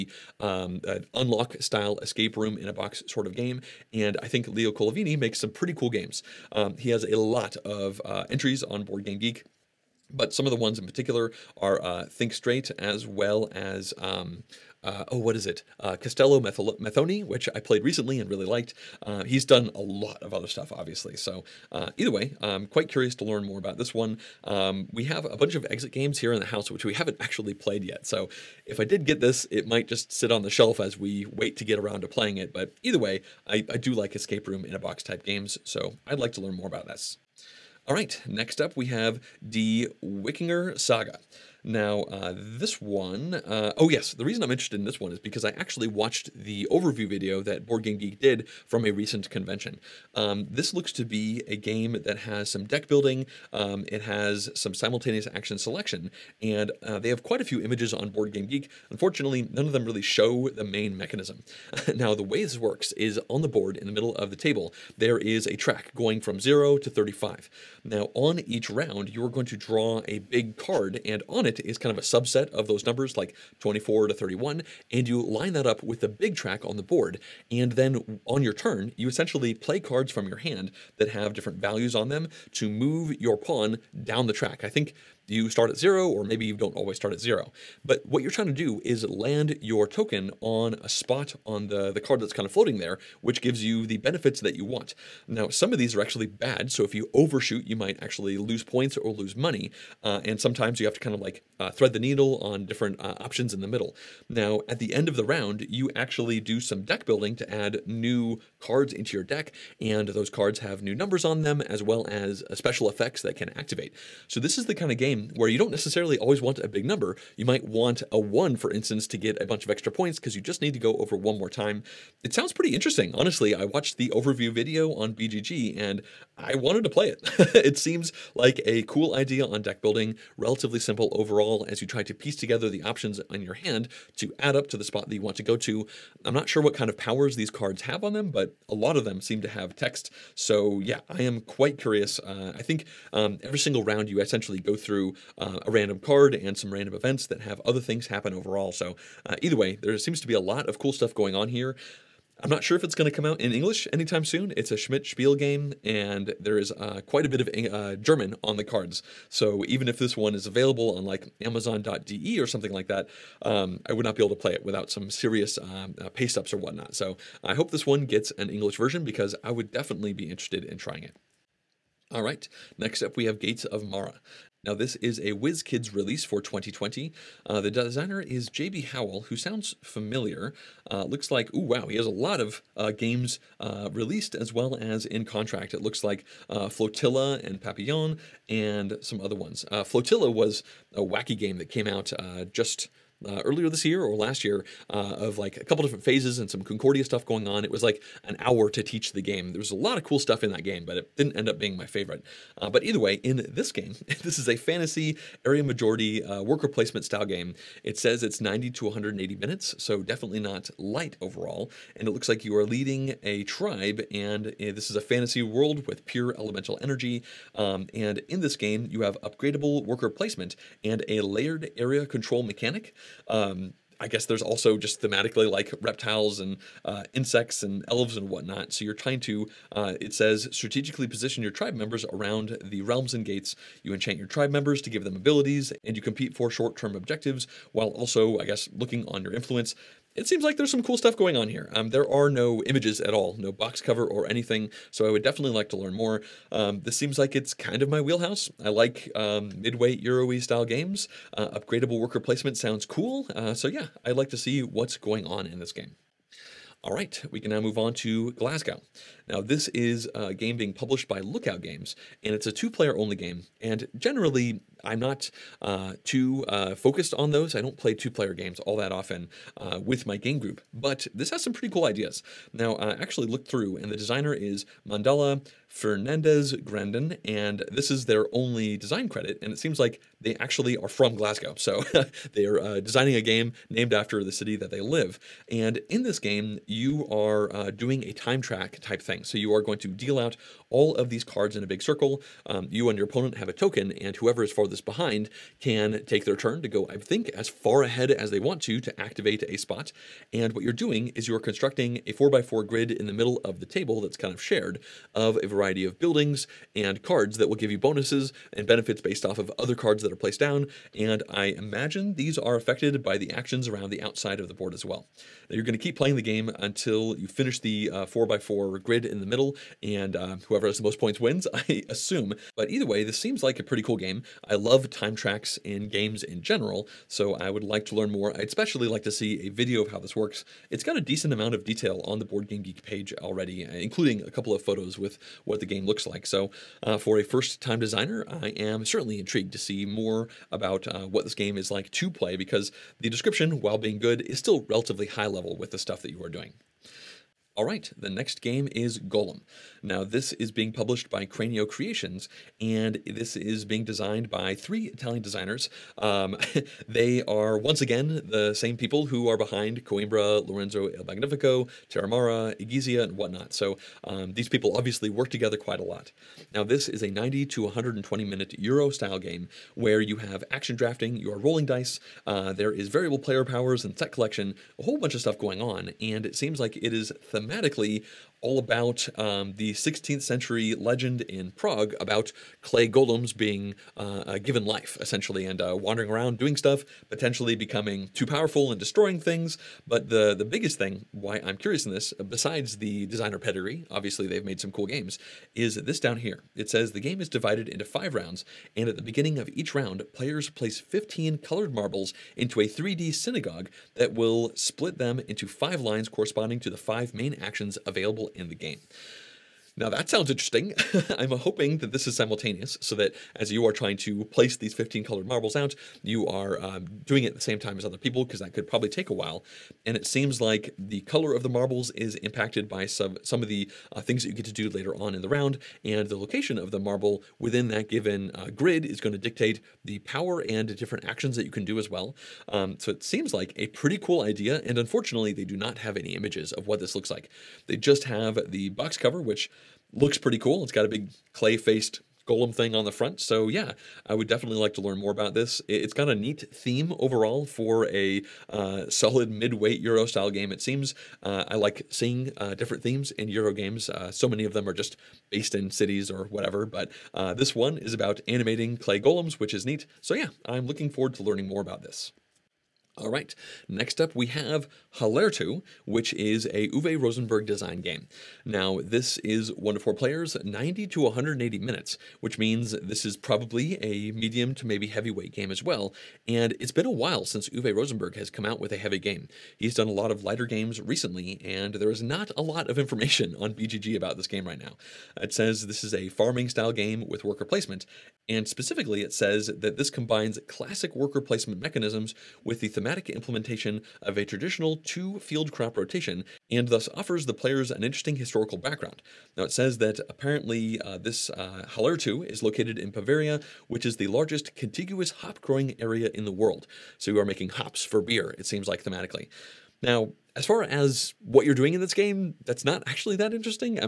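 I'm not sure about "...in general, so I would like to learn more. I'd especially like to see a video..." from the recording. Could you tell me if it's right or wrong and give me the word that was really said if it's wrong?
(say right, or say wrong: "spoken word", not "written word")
right.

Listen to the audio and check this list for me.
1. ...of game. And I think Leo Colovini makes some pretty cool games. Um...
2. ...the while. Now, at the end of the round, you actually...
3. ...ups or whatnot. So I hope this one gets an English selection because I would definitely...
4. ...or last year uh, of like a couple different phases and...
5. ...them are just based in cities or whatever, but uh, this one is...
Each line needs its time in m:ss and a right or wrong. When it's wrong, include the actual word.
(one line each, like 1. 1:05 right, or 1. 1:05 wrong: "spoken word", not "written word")
1. 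0:03 right
2. 1:43 wrong: "middle", not "while"
3. 2:46 wrong: "version", not "selection"
4. 3:14 right
5. 7:34 right.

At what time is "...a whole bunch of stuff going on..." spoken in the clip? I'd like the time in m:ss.
6:14.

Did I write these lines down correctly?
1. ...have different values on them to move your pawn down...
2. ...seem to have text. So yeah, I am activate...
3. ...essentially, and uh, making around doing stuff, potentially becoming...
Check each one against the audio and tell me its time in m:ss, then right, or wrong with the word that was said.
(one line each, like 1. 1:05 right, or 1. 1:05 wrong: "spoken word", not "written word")
1. 1:21 right
2. 2:19 wrong: "quite", not "activate"
3. 6:25 wrong: "wandering", not "making".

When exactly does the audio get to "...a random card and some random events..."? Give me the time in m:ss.
2:25.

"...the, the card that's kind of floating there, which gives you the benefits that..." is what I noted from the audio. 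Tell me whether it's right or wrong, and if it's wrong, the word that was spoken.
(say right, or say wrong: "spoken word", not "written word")
right.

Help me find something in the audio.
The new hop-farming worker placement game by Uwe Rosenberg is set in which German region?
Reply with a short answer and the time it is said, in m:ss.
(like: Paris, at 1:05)
Bavaria, at 8:22.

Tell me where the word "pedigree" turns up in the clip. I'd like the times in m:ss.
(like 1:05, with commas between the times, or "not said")
6:33.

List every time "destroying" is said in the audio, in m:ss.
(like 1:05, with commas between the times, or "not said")
6:28.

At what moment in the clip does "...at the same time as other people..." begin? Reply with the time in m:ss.
6:57.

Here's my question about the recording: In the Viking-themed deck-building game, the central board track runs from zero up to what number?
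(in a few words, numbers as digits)
35.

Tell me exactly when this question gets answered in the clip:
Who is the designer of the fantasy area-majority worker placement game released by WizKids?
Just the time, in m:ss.
2:58.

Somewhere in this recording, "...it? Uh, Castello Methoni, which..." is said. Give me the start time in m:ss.
0:15.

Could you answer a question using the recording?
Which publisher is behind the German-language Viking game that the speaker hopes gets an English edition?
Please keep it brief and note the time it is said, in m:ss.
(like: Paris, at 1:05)
Schmidt Spiel, at 2:34.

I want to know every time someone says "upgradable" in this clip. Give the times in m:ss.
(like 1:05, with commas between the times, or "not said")
3:39, 4:11.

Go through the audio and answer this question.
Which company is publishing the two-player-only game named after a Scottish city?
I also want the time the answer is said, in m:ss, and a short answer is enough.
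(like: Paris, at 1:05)
Lookout Games, at 4:21.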